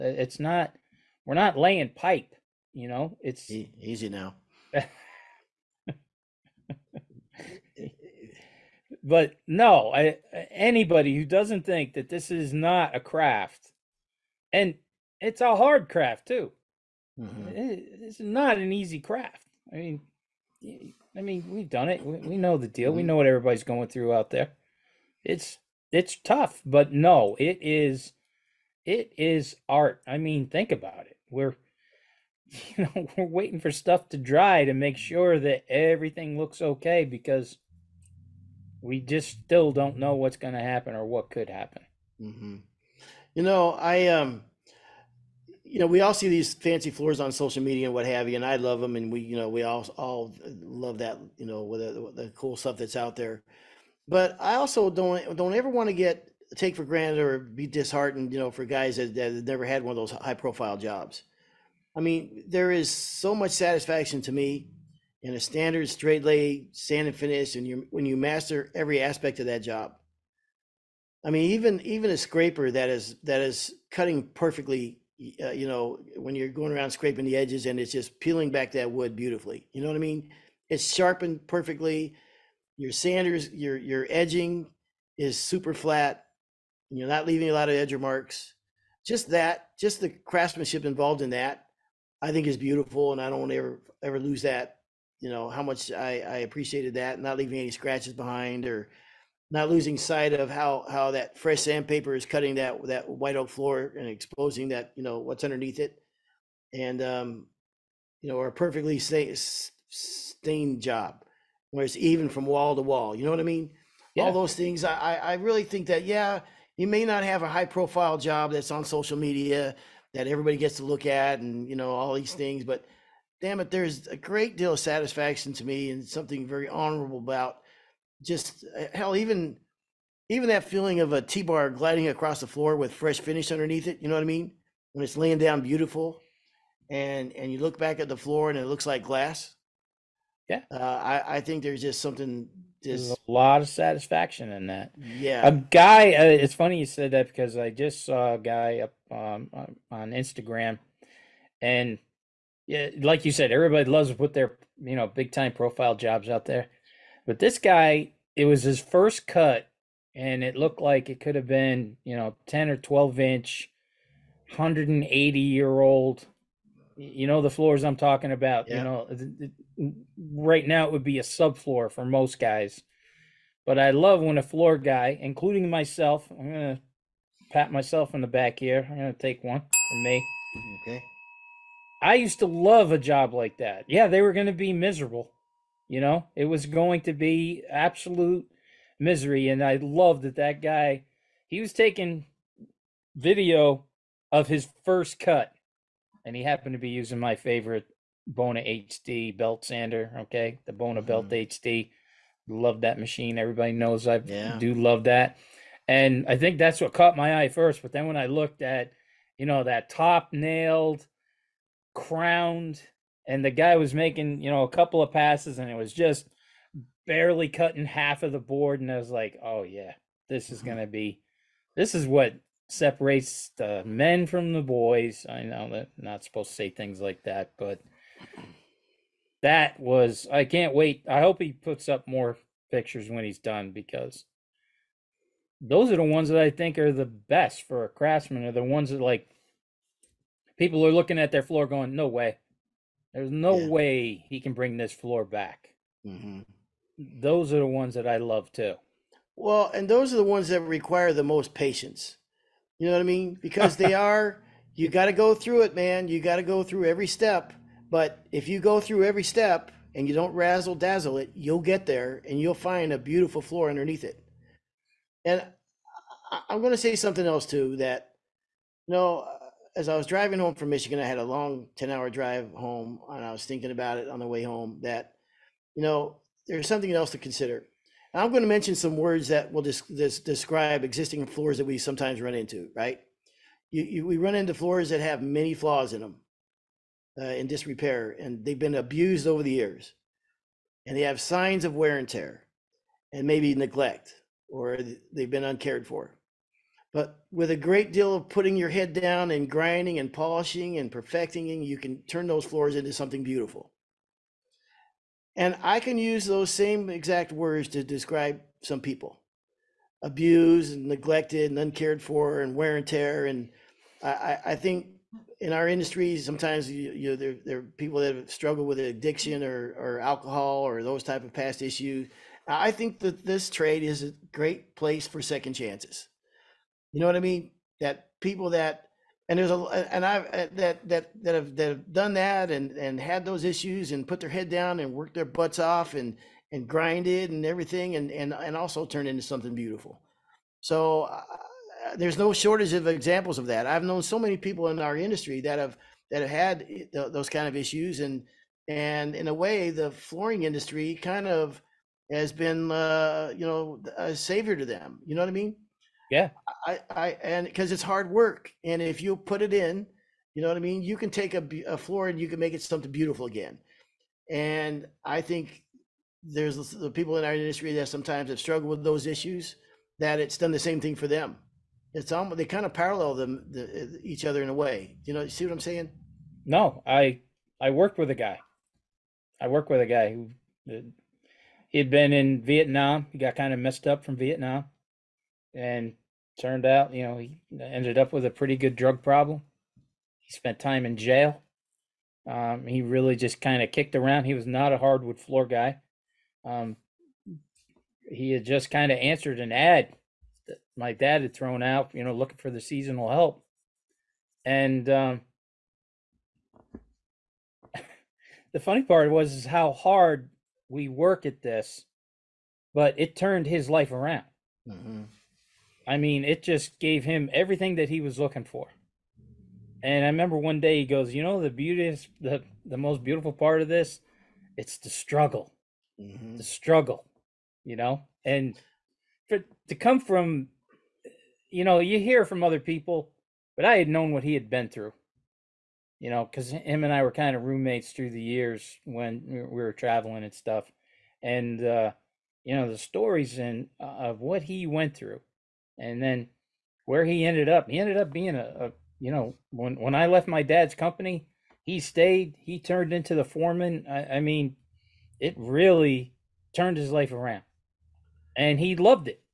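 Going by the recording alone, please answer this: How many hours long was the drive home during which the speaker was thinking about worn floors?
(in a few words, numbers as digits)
10.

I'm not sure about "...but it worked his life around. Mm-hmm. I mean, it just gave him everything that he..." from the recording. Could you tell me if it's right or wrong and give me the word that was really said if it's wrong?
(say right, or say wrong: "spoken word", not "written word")
wrong: "turned", not "worked".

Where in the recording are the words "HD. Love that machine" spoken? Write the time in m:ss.
3:21.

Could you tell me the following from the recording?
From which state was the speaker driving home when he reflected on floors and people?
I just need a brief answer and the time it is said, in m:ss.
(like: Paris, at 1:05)
Michigan, at 4:30.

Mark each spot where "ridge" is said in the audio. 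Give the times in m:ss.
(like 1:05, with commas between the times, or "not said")
not said.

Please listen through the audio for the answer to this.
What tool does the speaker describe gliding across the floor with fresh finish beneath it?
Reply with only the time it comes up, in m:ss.
2:11.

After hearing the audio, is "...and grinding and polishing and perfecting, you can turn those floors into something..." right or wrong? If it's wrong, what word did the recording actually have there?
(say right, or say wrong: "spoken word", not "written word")
right.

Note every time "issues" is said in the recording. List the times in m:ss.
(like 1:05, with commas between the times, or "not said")
5:21, 5:33, 5:47, 6:09.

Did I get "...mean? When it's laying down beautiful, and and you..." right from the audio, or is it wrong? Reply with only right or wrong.
right.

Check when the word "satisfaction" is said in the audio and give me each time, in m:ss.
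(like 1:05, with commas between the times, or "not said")
1:03, 2:04, 2:23.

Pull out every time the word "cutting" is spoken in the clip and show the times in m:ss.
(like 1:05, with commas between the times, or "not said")
1:13, 1:42, 3:37.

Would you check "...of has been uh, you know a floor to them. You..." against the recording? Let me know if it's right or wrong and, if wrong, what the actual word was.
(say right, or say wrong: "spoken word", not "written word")
wrong: "savior", not "floor".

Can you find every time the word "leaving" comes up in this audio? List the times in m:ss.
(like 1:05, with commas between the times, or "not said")
1:27, 1:37.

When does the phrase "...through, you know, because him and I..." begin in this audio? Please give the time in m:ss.
7:14.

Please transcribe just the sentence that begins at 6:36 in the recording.
Um, he had just kind of answered an ad that my dad had thrown out, you know, looking for the seasonal help.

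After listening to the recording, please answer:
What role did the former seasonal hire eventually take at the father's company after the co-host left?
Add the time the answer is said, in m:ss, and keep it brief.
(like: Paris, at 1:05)
Foreman, at 7:33.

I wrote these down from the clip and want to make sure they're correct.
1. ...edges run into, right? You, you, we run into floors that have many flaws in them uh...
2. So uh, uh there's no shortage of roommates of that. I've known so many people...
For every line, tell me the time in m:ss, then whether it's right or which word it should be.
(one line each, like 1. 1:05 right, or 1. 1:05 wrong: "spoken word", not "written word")
1. 4:41 wrong: "sometimes", not "edges"
2. 5:40 wrong: "examples", not "roommates".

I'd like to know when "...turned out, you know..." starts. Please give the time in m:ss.
6:26.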